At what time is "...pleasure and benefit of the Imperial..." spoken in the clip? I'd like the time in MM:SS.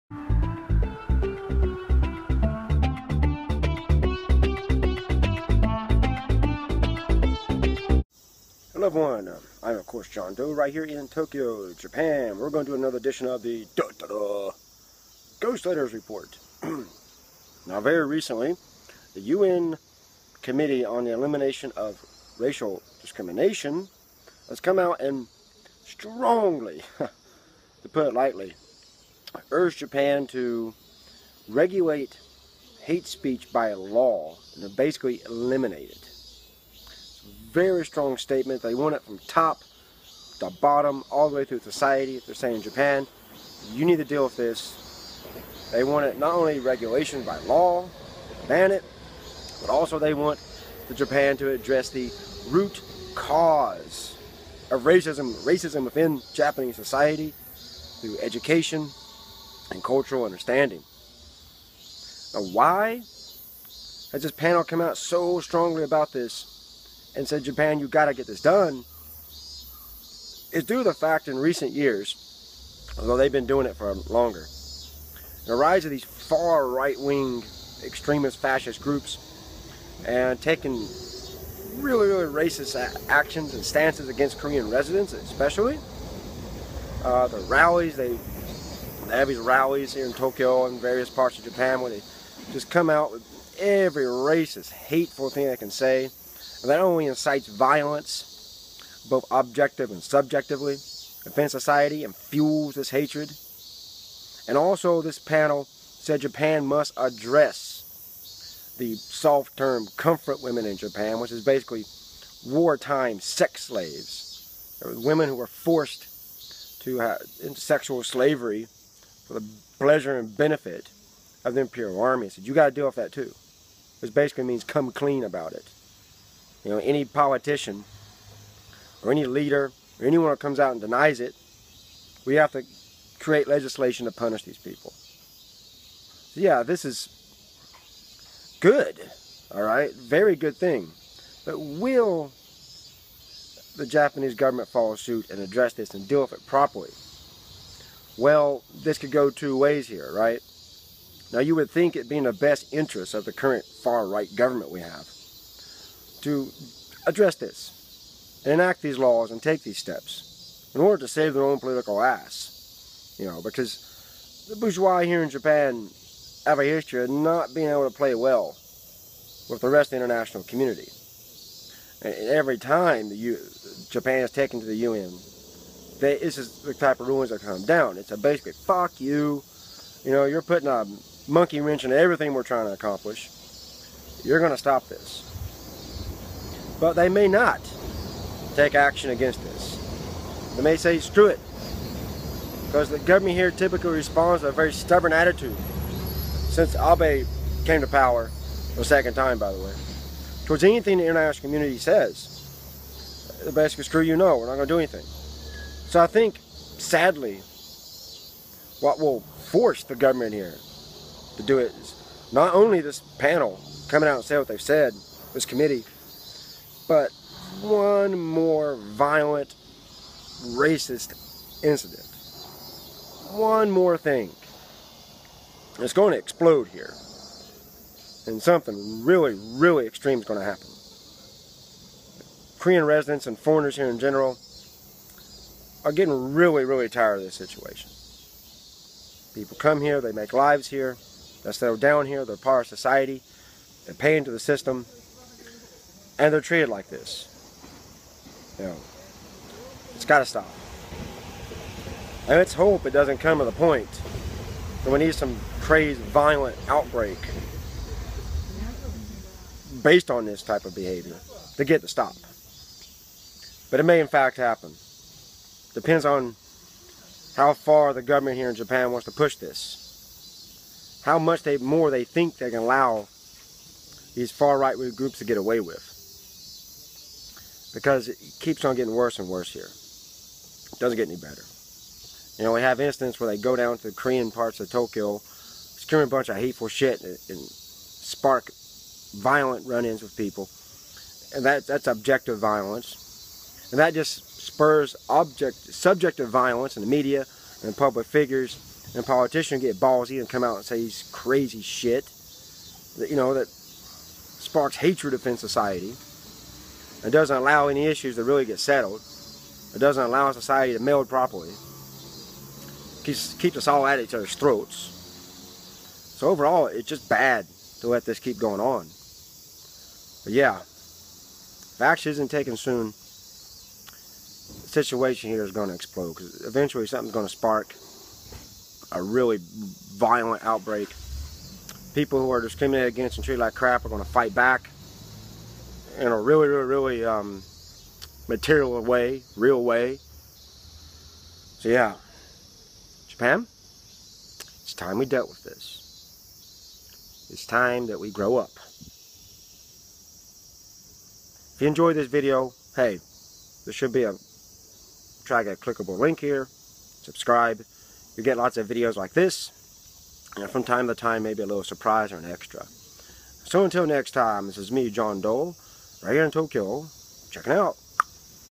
01:59.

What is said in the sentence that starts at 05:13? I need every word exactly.
keeps, keeps us all at each other's throats.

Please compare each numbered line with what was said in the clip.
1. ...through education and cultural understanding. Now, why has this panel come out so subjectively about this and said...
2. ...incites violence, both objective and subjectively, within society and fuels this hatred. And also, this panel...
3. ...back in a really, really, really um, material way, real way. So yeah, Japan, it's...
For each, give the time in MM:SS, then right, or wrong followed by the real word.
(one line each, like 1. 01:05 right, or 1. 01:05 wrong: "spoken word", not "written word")
1. 00:57 wrong: "strongly", not "subjectively"
2. 01:37 right
3. 05:34 right.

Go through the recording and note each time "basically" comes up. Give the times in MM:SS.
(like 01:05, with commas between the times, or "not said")
00:34, 01:51, 02:04, 02:58, 03:23.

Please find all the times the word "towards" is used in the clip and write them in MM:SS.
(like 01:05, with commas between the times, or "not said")
03:20.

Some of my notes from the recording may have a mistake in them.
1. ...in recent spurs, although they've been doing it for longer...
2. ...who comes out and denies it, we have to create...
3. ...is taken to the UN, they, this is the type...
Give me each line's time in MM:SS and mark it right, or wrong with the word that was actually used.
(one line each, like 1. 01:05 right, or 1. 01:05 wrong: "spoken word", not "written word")
1. 01:11 wrong: "years", not "spurs"
2. 02:10 right
3. 02:54 right.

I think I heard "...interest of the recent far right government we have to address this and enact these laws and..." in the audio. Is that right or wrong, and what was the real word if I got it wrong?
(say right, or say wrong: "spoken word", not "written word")
wrong: "current", not "recent".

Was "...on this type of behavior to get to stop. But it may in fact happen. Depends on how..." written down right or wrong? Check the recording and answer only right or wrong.
right.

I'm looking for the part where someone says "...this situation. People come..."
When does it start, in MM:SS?
03:57.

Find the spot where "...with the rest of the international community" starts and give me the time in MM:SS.
02:49.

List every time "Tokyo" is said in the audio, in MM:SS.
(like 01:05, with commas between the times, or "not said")
00:11, 01:30, 04:44, 06:06.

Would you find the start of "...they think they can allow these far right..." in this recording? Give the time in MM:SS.
04:31.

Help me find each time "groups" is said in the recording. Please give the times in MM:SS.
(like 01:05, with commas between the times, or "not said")
01:18, 04:34.